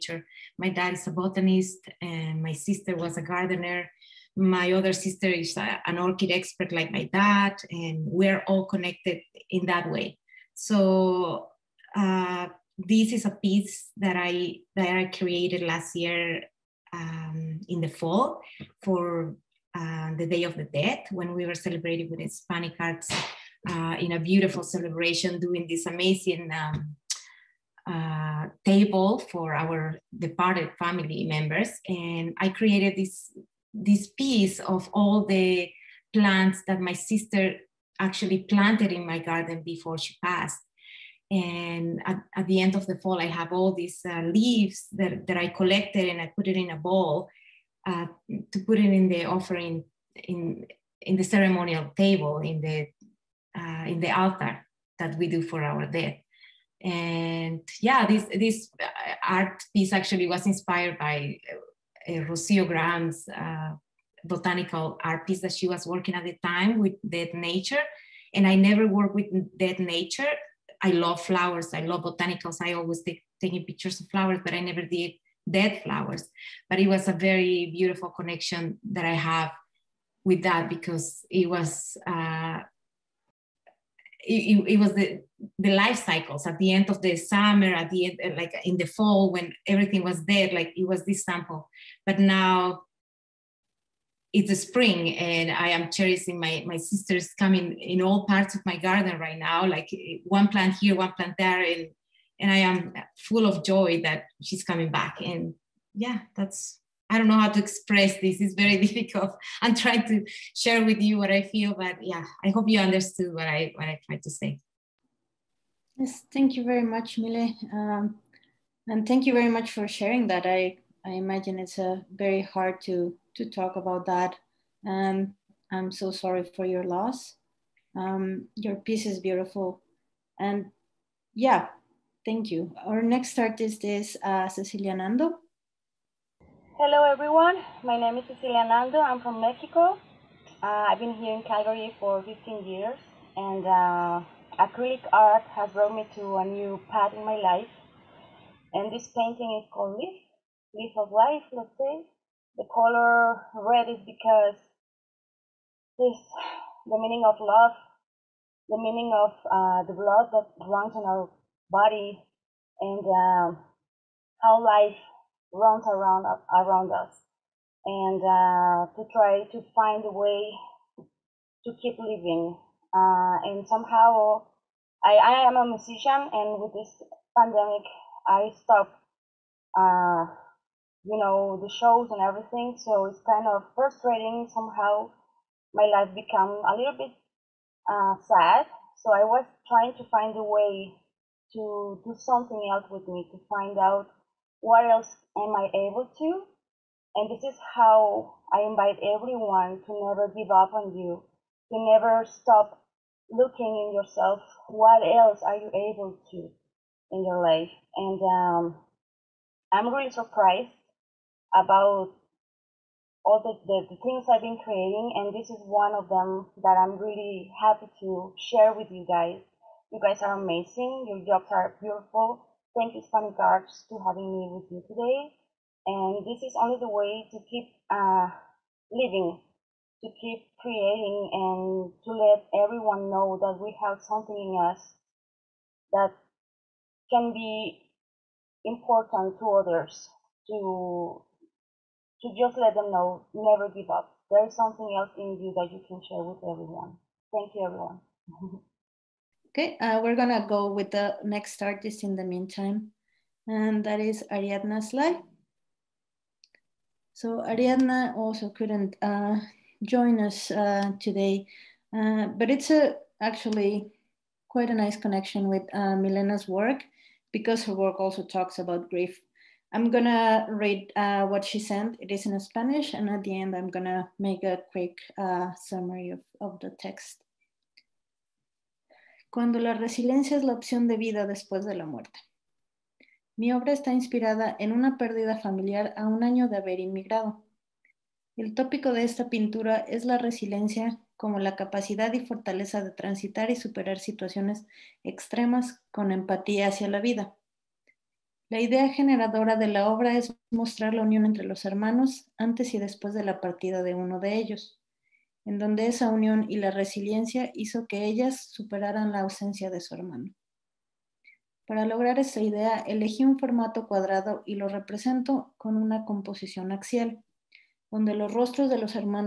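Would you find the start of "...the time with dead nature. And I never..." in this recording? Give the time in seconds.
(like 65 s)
66 s.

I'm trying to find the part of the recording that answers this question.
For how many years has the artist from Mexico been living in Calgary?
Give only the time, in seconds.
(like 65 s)
142 s.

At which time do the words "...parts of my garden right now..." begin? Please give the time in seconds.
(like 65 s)
98 s.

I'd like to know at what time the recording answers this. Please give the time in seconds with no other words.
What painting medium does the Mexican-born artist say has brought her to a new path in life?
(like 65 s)
144 s.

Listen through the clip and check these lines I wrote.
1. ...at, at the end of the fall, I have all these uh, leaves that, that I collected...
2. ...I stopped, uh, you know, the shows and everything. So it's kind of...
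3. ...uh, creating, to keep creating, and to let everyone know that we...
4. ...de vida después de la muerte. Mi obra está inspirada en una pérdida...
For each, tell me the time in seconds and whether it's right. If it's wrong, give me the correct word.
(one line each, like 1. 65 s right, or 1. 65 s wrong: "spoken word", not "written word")
1. 42 s right
2. 178 s right
3. 227 s wrong: "living", not "creating"
4. 280 s right.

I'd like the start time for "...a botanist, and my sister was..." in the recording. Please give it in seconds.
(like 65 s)
1 s.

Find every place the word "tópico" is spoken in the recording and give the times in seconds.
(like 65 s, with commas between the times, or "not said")
288 s.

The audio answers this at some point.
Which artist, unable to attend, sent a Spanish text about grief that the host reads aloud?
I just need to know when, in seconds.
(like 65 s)
254 s.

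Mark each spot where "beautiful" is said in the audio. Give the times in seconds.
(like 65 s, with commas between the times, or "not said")
24 s, 77 s, 129 s, 221 s.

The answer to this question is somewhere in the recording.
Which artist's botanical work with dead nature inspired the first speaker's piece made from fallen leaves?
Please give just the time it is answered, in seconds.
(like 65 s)
62 s.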